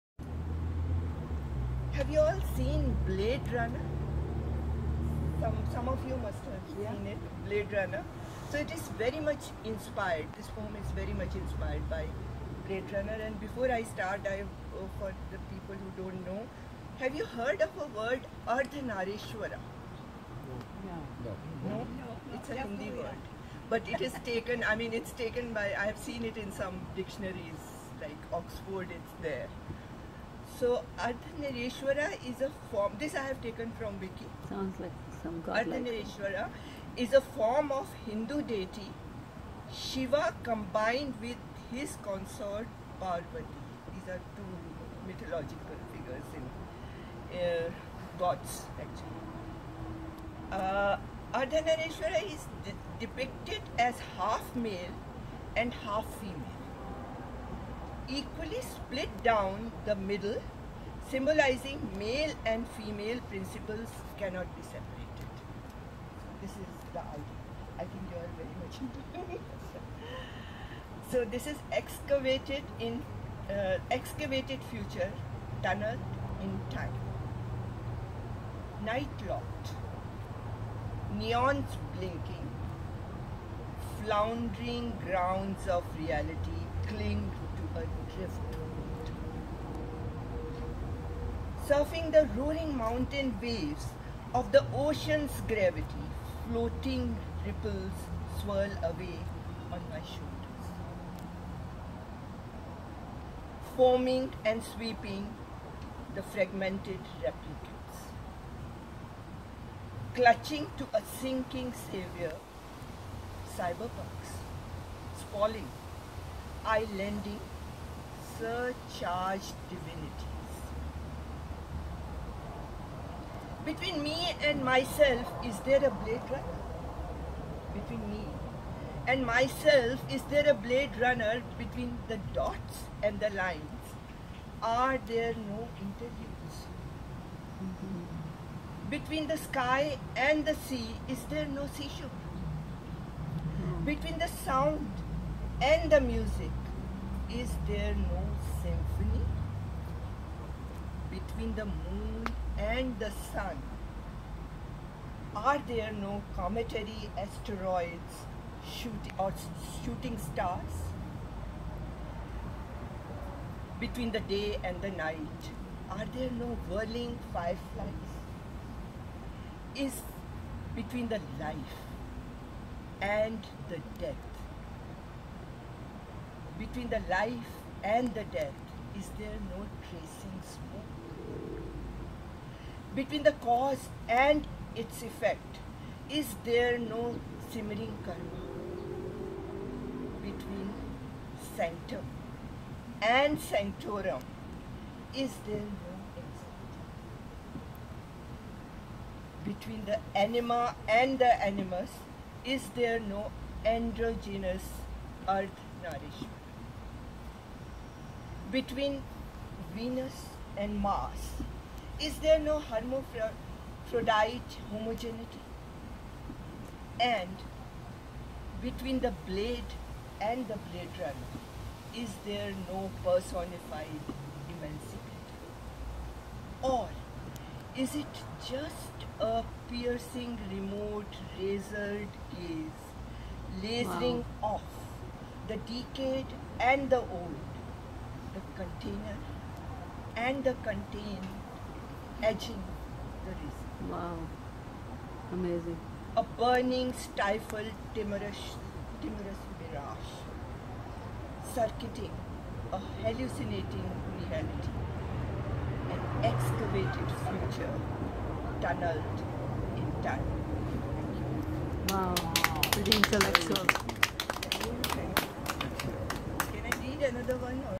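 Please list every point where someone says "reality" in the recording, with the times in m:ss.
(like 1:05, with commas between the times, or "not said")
1:25, 4:14.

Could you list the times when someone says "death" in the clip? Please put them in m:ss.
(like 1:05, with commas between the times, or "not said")
2:53, 2:58.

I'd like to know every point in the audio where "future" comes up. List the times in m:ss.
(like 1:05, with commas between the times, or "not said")
1:14, 4:17.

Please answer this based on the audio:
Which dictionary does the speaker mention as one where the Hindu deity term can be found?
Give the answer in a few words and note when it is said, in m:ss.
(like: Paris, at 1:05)
Oxford, at 0:28.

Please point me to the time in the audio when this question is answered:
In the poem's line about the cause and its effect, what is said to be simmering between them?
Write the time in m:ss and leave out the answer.
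3:08.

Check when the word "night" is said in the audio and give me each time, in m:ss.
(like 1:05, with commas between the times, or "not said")
1:18, 2:44.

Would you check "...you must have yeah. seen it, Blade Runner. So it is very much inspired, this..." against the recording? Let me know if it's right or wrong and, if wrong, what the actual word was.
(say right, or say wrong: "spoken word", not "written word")
right.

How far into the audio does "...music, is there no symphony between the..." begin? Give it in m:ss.
2:26.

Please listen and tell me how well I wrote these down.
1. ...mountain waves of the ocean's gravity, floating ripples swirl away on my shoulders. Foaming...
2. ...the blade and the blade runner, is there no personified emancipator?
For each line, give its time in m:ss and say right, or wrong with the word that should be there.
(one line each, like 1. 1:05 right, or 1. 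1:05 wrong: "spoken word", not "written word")
1. 1:32 right
2. 3:38 right.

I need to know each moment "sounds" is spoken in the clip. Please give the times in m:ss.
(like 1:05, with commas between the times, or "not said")
0:34, 2:24.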